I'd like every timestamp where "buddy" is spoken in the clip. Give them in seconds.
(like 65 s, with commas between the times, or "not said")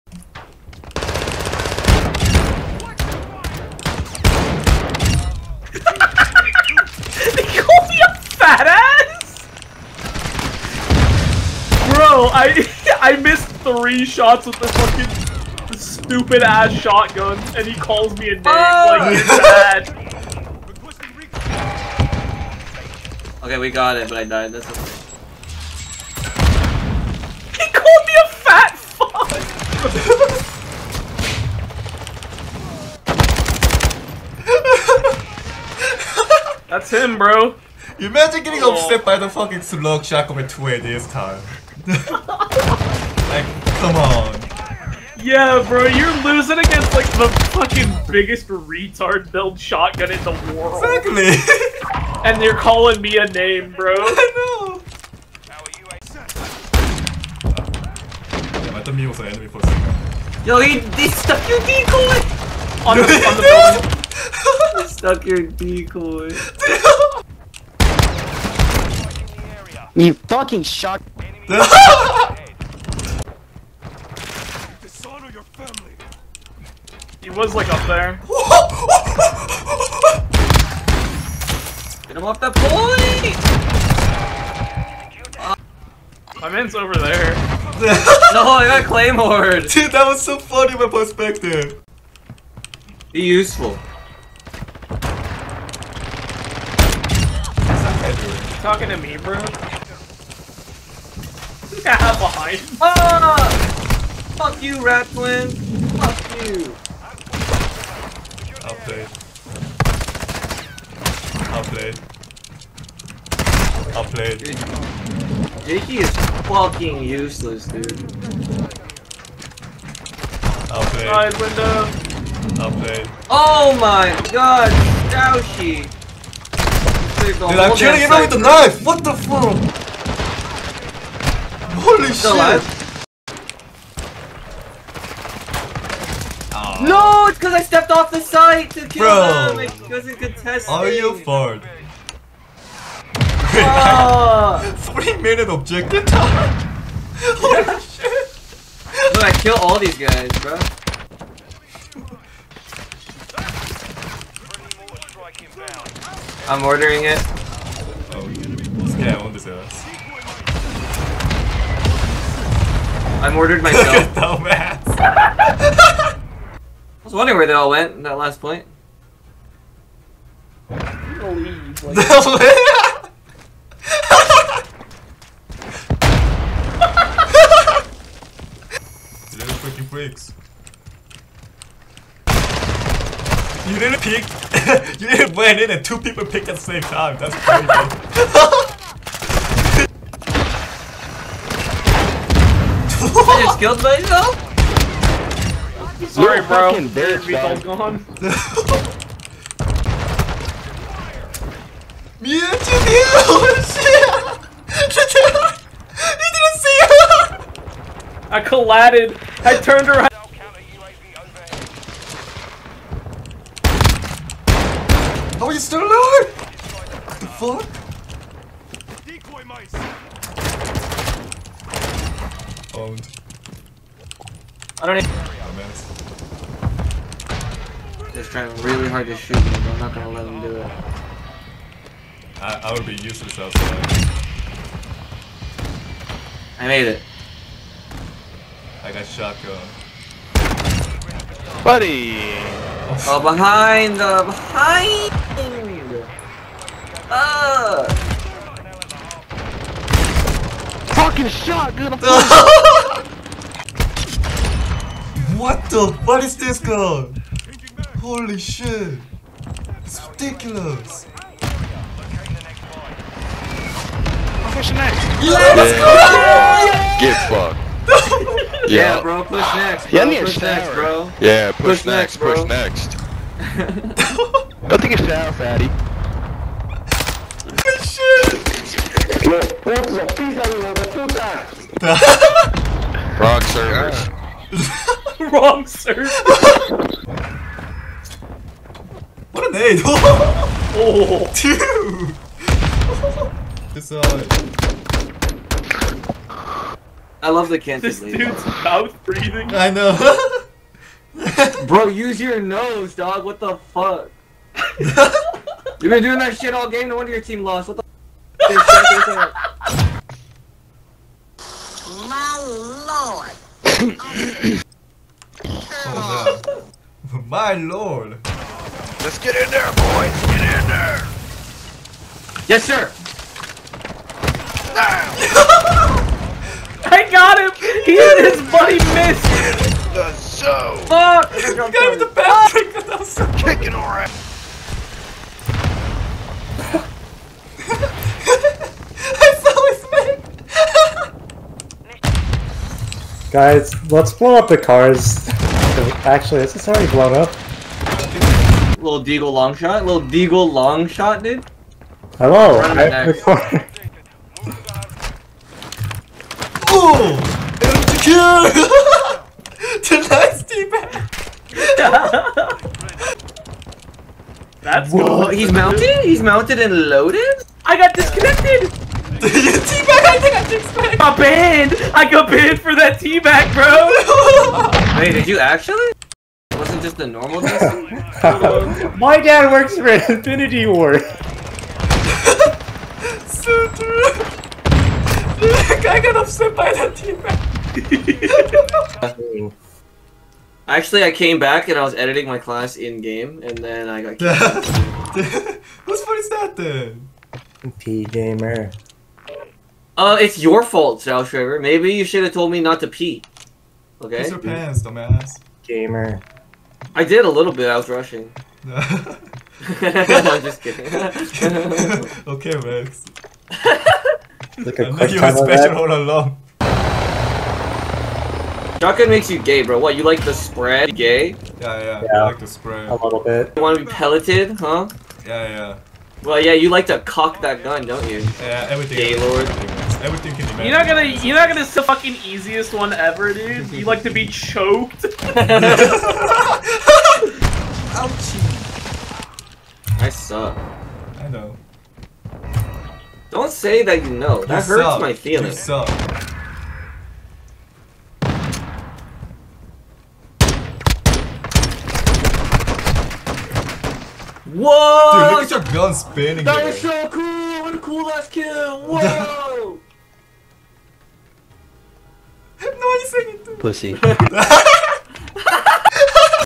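241 s, 328 s.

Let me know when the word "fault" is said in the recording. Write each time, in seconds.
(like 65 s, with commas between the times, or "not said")
396 s, 400 s.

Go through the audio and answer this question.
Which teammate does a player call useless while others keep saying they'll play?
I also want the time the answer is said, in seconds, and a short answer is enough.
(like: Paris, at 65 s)
Jakey, at 115 s.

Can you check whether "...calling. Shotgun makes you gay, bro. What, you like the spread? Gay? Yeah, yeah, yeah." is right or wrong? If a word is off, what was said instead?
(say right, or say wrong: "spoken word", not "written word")
wrong: "along", not "calling".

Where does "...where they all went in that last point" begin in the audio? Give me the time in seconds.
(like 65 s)
167 s.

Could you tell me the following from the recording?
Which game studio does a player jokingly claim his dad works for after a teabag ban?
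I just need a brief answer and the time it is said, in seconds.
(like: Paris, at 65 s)
Infinity Ward, at 379 s.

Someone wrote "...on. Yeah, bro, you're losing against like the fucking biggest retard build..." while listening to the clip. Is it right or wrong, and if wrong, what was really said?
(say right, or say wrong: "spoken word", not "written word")
right.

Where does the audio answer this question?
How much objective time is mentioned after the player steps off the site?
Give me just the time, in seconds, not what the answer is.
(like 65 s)
144 s.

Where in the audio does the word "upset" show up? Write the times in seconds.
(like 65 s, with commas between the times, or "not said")
38 s, 386 s.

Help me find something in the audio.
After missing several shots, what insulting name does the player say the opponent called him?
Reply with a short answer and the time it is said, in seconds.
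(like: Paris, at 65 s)
fat fuck, at 28 s.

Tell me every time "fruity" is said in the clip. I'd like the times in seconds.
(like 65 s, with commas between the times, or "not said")
not said.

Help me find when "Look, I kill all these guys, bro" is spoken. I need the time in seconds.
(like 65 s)
149 s.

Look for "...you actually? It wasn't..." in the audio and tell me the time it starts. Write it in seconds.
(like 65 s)
375 s.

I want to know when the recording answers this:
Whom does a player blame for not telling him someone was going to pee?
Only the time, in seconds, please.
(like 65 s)
401 s.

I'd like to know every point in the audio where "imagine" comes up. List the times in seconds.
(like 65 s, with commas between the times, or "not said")
38 s, 430 s.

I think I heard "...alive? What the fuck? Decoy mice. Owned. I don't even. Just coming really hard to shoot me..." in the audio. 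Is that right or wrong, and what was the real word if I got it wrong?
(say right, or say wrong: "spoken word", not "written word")
wrong: "trying", not "coming".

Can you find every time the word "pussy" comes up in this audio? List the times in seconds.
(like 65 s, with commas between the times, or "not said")
59 s, 463 s.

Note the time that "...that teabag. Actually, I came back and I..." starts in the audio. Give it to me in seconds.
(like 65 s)
386 s.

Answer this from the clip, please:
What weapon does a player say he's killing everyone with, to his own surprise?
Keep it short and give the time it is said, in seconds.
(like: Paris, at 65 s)
knife, at 128 s.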